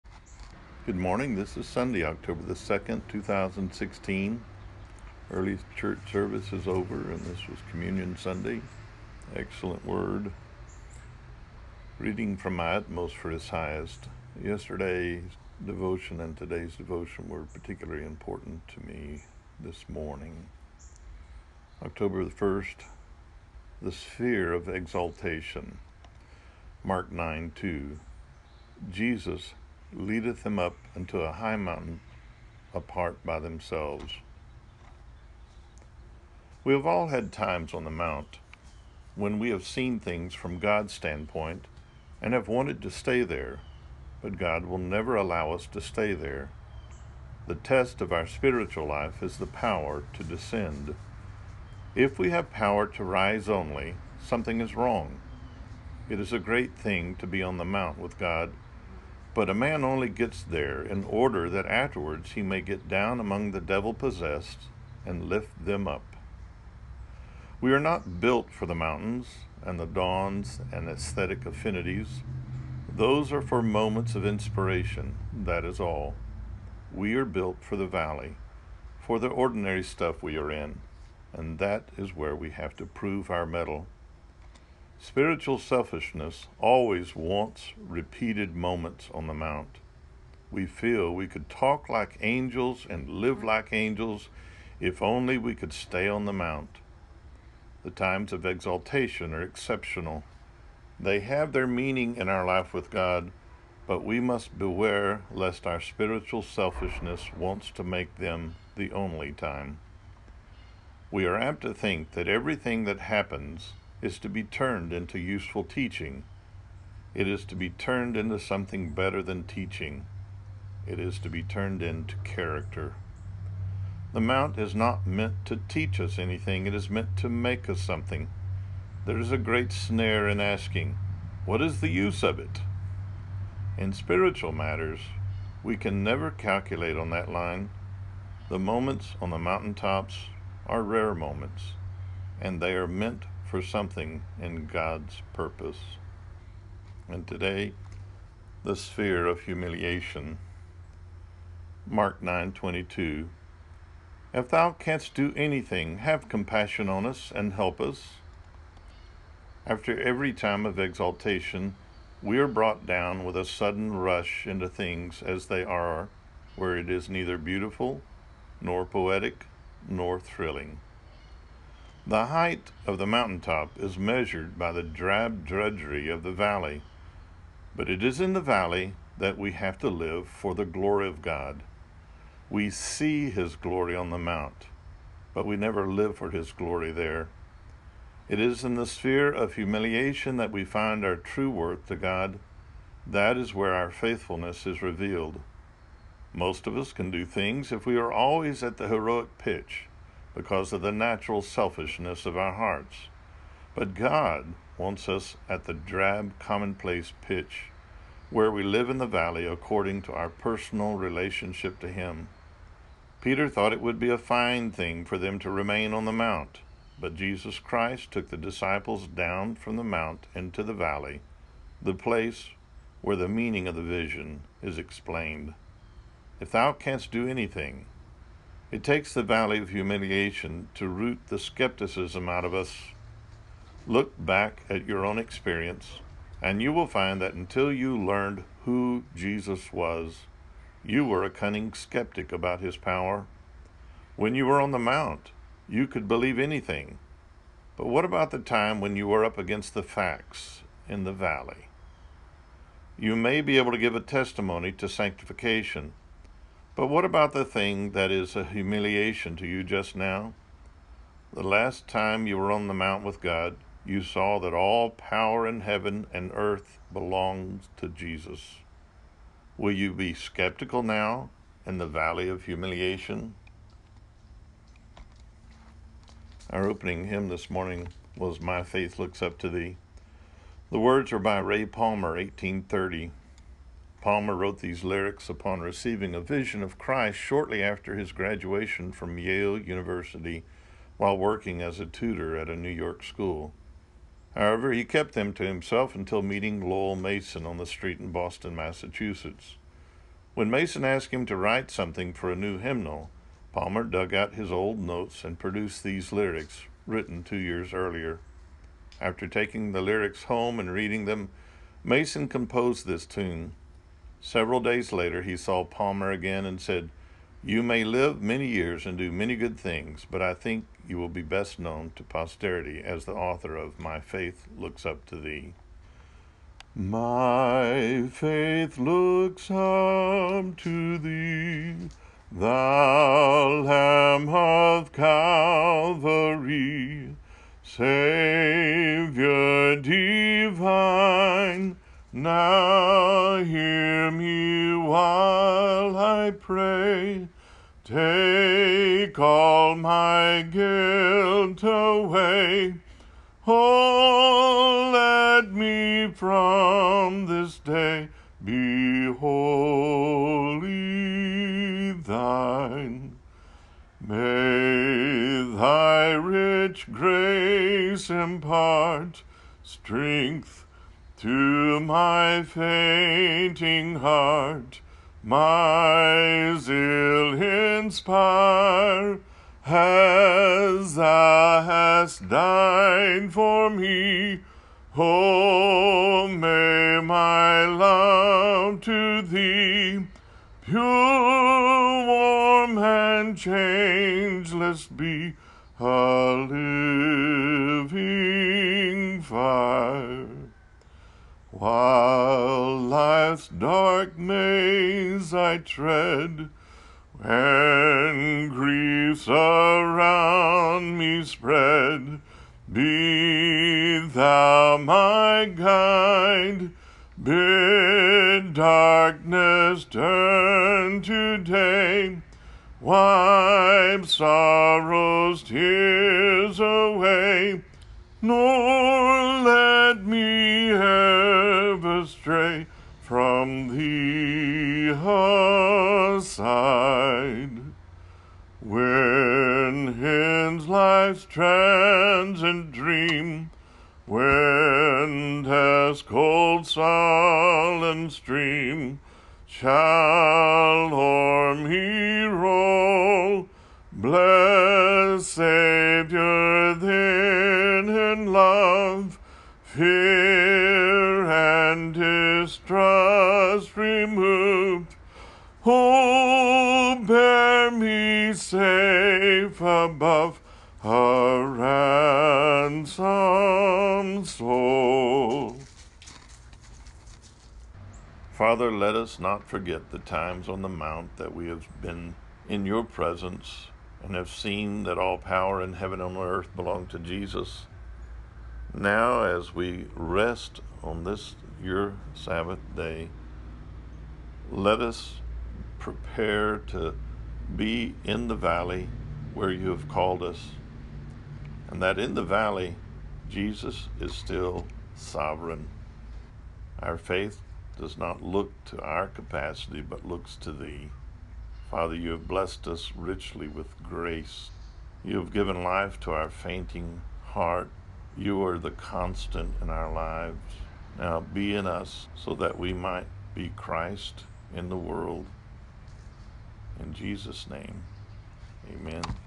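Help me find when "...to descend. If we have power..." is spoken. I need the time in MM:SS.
00:50.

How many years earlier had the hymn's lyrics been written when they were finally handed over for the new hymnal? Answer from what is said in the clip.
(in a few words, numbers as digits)
2.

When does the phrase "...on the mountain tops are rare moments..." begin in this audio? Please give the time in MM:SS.
02:19.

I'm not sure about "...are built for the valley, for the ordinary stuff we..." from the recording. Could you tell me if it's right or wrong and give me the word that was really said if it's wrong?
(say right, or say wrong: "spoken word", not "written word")
right.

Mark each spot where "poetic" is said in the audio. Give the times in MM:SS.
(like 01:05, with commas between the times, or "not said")
02:48.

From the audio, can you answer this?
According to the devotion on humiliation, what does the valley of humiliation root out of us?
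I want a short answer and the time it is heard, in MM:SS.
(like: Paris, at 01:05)
Skepticism, at 03:51.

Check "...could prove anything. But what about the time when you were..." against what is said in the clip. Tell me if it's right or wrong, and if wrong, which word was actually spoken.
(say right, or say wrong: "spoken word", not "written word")
wrong: "believe", not "prove".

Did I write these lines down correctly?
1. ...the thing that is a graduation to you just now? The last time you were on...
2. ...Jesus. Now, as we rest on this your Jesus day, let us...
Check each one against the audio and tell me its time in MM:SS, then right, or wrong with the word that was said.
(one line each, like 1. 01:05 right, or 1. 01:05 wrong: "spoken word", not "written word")
1. 04:17 wrong: "humiliation", not "graduation"
2. 08:06 wrong: "Sabbath", not "Jesus".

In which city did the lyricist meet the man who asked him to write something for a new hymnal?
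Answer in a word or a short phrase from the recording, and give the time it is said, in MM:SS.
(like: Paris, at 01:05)
Boston, at 04:58.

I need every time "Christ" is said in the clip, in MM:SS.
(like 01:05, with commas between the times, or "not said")
03:37, 04:46, 08:43.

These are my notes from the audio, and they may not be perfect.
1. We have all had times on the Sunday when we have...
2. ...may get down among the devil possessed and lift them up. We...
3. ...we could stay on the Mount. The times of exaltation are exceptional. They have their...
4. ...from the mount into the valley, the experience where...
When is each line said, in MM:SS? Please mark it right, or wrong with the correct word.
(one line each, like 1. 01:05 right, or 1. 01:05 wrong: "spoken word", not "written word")
1. 00:36 wrong: "Mount", not "Sunday"
2. 01:02 right
3. 01:35 right
4. 03:39 wrong: "place", not "experience".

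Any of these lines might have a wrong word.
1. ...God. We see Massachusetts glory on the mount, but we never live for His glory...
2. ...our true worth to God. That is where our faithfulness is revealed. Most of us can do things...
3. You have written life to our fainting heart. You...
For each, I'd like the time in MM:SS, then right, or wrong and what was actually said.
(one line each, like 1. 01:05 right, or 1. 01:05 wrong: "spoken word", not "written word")
1. 03:01 wrong: "His", not "Massachusetts"
2. 03:11 right
3. 08:35 wrong: "given", not "written".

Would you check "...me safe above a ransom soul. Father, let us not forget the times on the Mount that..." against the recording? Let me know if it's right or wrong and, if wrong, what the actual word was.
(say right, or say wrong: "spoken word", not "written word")
right.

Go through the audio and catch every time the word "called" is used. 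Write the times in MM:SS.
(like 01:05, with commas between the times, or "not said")
08:19.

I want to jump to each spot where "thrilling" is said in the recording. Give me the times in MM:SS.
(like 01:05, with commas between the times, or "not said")
02:50.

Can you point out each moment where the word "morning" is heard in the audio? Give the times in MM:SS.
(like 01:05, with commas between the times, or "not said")
00:00, 00:19, 04:37.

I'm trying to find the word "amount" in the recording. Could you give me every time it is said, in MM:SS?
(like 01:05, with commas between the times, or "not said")
not said.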